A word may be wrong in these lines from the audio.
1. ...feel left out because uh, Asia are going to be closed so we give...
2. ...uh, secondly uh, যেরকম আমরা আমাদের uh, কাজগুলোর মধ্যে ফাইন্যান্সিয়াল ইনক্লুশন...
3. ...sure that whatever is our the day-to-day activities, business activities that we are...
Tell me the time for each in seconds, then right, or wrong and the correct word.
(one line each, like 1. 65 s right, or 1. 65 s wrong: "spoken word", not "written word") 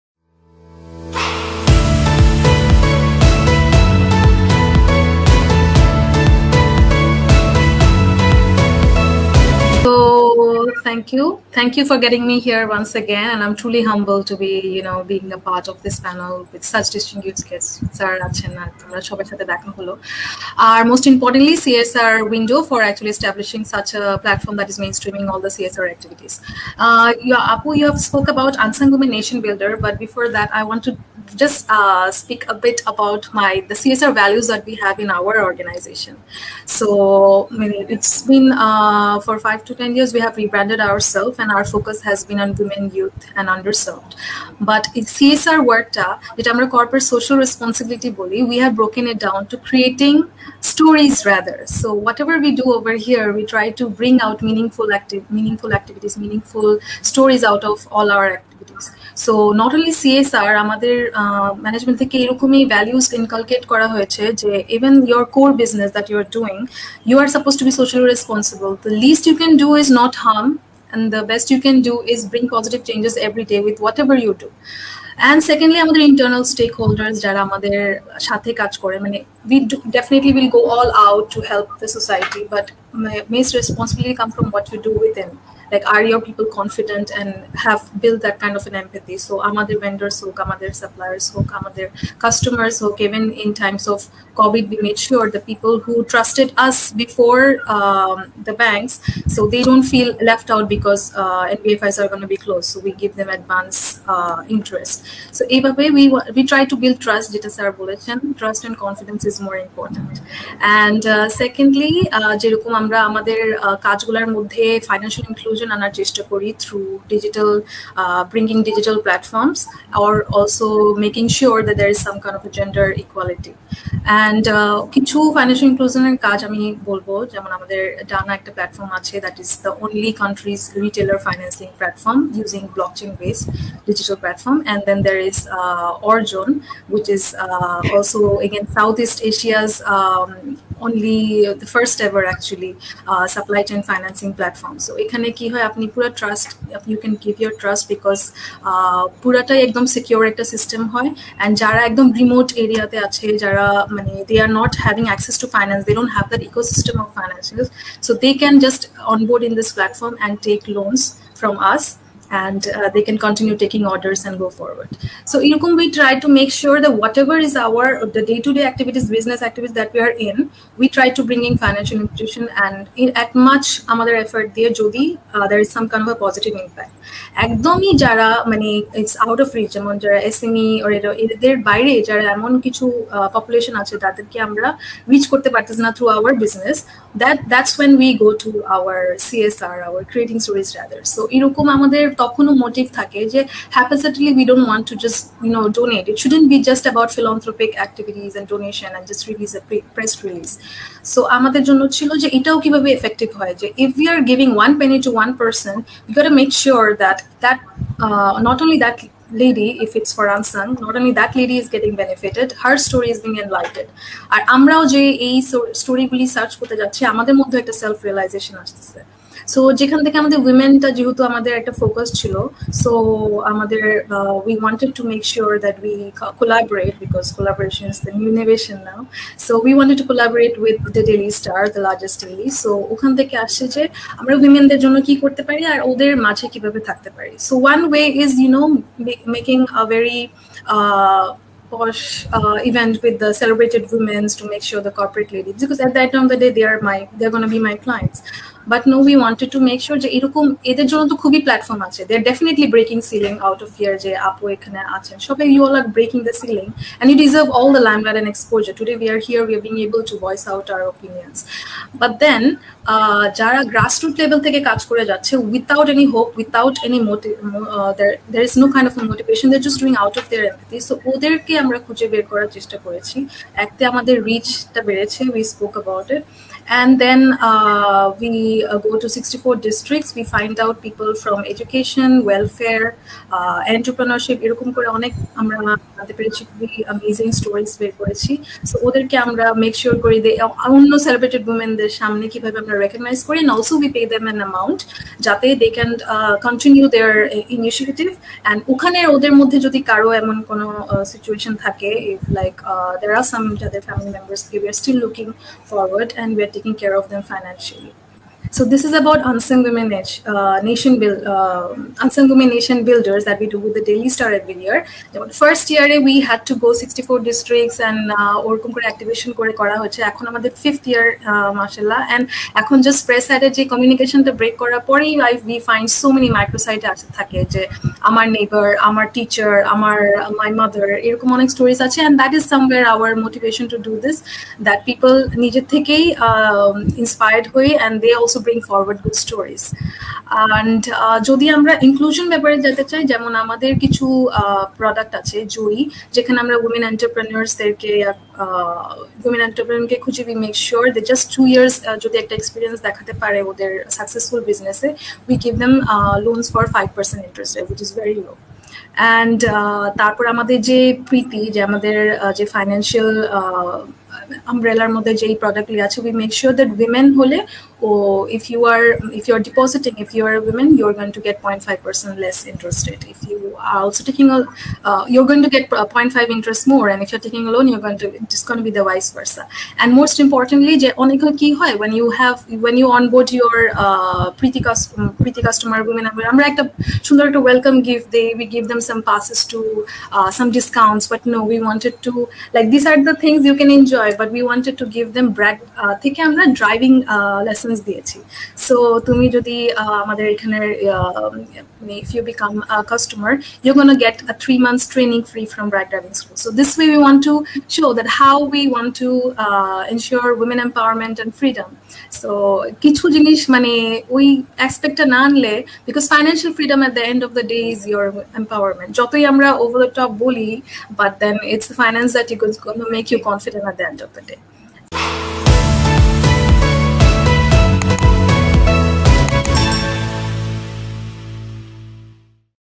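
1. 99 s wrong: "NBFIs", not "Asia"
2. 111 s right
3. 166 s right.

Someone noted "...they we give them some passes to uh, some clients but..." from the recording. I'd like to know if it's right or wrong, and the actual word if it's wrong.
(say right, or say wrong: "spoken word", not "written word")
wrong: "discounts", not "clients".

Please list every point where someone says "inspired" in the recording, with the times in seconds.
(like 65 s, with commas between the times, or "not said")
336 s.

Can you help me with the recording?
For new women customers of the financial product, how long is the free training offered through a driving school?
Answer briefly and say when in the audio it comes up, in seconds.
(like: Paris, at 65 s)
3 months, at 404 s.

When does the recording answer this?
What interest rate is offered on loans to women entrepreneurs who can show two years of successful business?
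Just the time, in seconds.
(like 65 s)
356 s.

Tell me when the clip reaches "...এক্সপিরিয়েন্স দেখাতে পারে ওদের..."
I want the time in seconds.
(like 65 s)
352 s.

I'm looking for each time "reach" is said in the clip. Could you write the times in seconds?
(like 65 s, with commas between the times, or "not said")
179 s, 185 s.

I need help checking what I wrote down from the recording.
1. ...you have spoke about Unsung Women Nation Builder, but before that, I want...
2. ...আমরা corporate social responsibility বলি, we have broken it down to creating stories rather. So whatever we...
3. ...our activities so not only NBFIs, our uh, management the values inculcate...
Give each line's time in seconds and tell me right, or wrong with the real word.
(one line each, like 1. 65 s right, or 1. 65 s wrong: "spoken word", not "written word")
1. 27 s right
2. 46 s right
3. 58 s wrong: "CSR", not "NBFIs".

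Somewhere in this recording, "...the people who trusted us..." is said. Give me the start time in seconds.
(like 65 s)
95 s.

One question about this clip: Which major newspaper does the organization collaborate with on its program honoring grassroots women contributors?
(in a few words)
The Daily Star.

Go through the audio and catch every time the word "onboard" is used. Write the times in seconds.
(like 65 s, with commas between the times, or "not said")
159 s, 382 s.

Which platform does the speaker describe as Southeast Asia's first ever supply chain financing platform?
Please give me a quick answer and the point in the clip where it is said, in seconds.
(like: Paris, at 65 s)
Orjon, at 136 s.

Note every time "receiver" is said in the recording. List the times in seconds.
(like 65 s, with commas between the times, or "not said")
not said.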